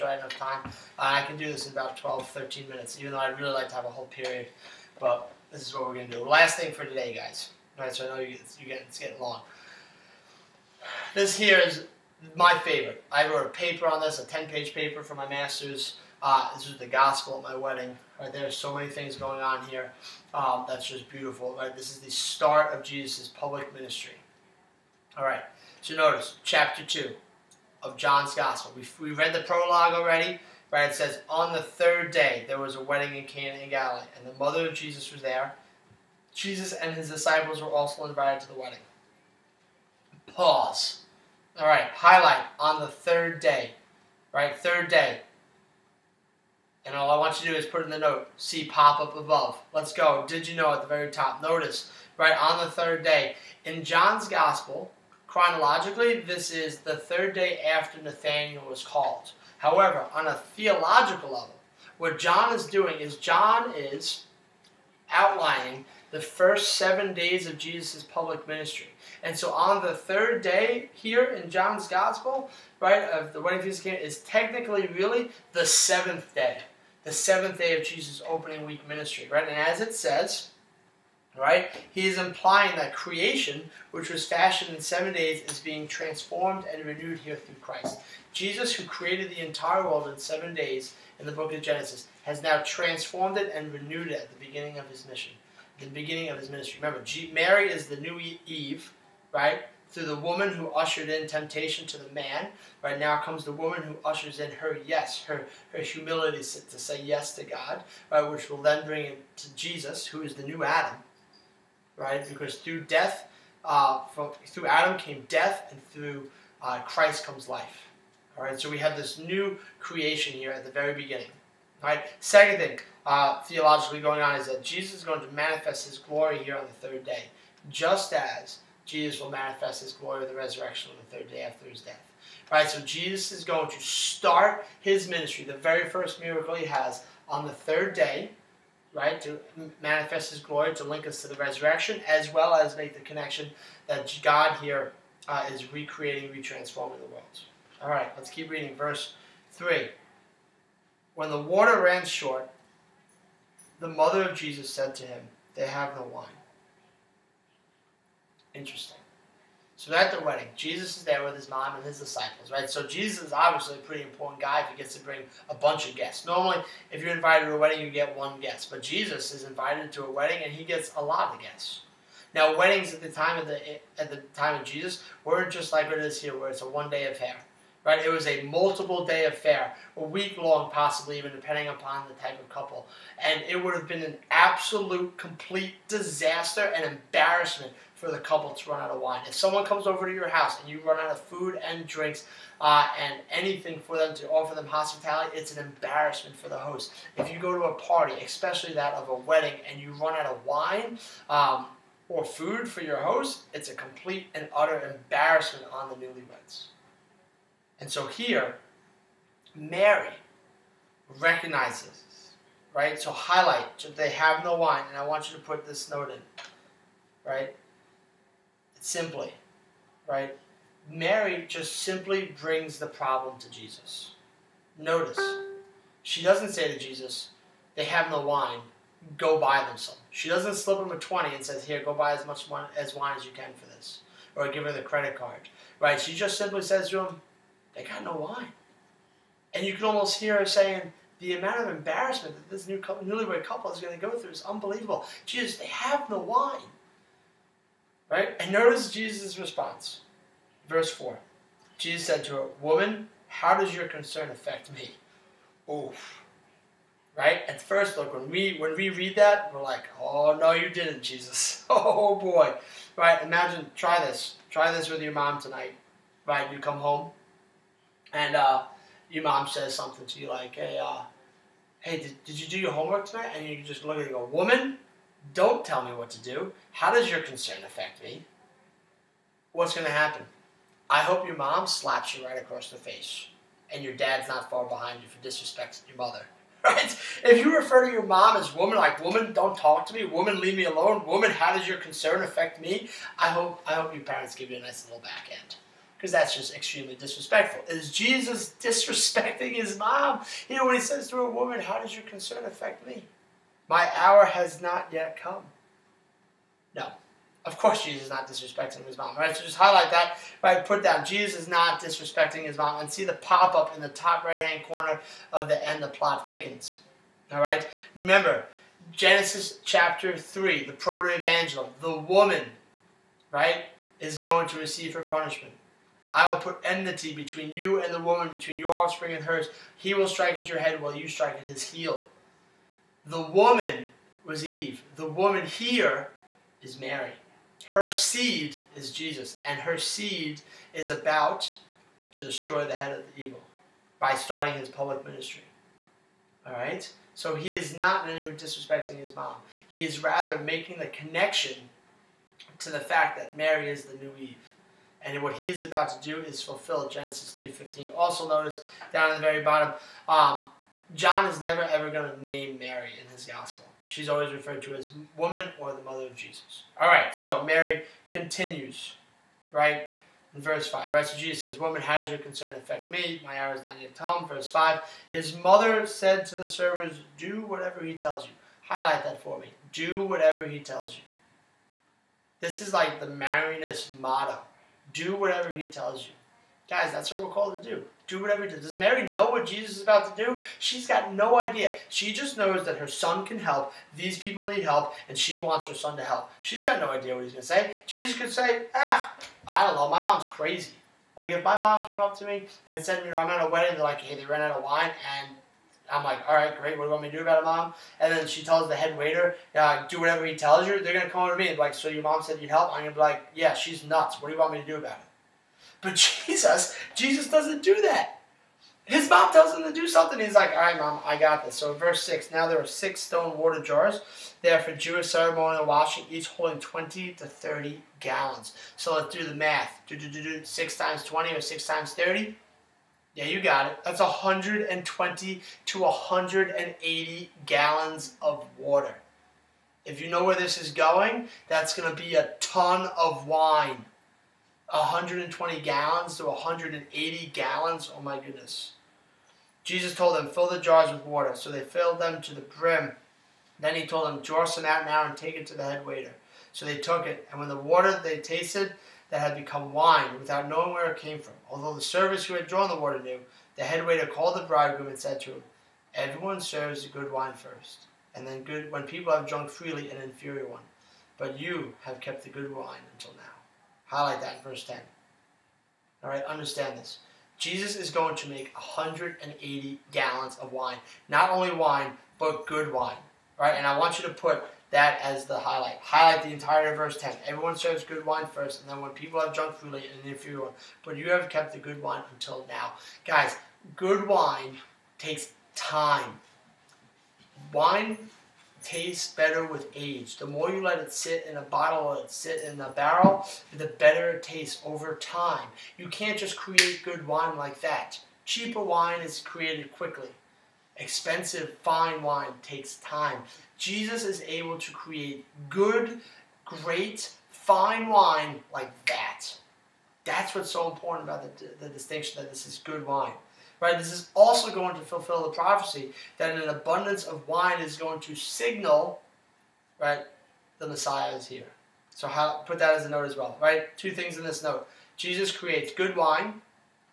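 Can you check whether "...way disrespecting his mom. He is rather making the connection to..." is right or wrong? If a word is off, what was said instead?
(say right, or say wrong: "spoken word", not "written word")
right.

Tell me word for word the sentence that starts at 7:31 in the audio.
So they filled them to the brim.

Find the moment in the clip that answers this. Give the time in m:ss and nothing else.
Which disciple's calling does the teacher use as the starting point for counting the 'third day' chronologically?
0:58.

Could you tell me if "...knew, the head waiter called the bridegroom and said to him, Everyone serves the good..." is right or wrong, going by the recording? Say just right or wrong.
right.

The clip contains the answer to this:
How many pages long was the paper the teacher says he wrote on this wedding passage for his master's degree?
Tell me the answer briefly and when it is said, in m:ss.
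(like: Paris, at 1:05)
10, at 0:14.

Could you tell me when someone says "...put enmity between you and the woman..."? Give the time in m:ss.
5:26.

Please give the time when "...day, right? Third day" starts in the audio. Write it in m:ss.
0:43.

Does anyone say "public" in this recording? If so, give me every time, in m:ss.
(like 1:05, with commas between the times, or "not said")
0:23, 1:08, 5:44.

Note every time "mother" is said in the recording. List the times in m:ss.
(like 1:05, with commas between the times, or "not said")
0:34, 2:33, 4:45, 6:05, 6:15.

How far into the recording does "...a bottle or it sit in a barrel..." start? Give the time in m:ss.
8:21.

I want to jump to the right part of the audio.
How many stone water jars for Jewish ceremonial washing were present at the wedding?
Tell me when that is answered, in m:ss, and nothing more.
7:02.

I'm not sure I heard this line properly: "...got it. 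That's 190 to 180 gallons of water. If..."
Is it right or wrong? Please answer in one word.
wrong.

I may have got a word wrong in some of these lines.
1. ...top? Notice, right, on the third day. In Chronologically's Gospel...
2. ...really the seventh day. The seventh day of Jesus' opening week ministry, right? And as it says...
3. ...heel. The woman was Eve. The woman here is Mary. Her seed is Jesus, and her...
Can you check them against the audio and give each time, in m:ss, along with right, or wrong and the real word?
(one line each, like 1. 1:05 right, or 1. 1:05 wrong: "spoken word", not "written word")
1. 0:51 wrong: "John", not "Chronologically"
2. 1:14 right
3. 5:31 right.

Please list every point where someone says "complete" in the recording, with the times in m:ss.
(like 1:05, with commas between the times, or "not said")
3:05, 3:23.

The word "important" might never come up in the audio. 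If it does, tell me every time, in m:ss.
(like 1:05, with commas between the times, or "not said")
2:44, 8:40.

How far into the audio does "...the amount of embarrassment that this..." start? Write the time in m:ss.
4:01.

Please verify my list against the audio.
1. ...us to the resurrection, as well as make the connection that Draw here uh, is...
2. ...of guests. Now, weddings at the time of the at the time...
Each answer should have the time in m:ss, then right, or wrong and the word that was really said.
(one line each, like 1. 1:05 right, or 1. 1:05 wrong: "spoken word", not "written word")
1. 2:21 wrong: "God", not "Draw"
2. 2:51 right.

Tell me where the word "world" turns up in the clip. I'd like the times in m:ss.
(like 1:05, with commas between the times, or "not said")
1:29, 2:27.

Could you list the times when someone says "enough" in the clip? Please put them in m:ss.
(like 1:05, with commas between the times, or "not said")
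0:00.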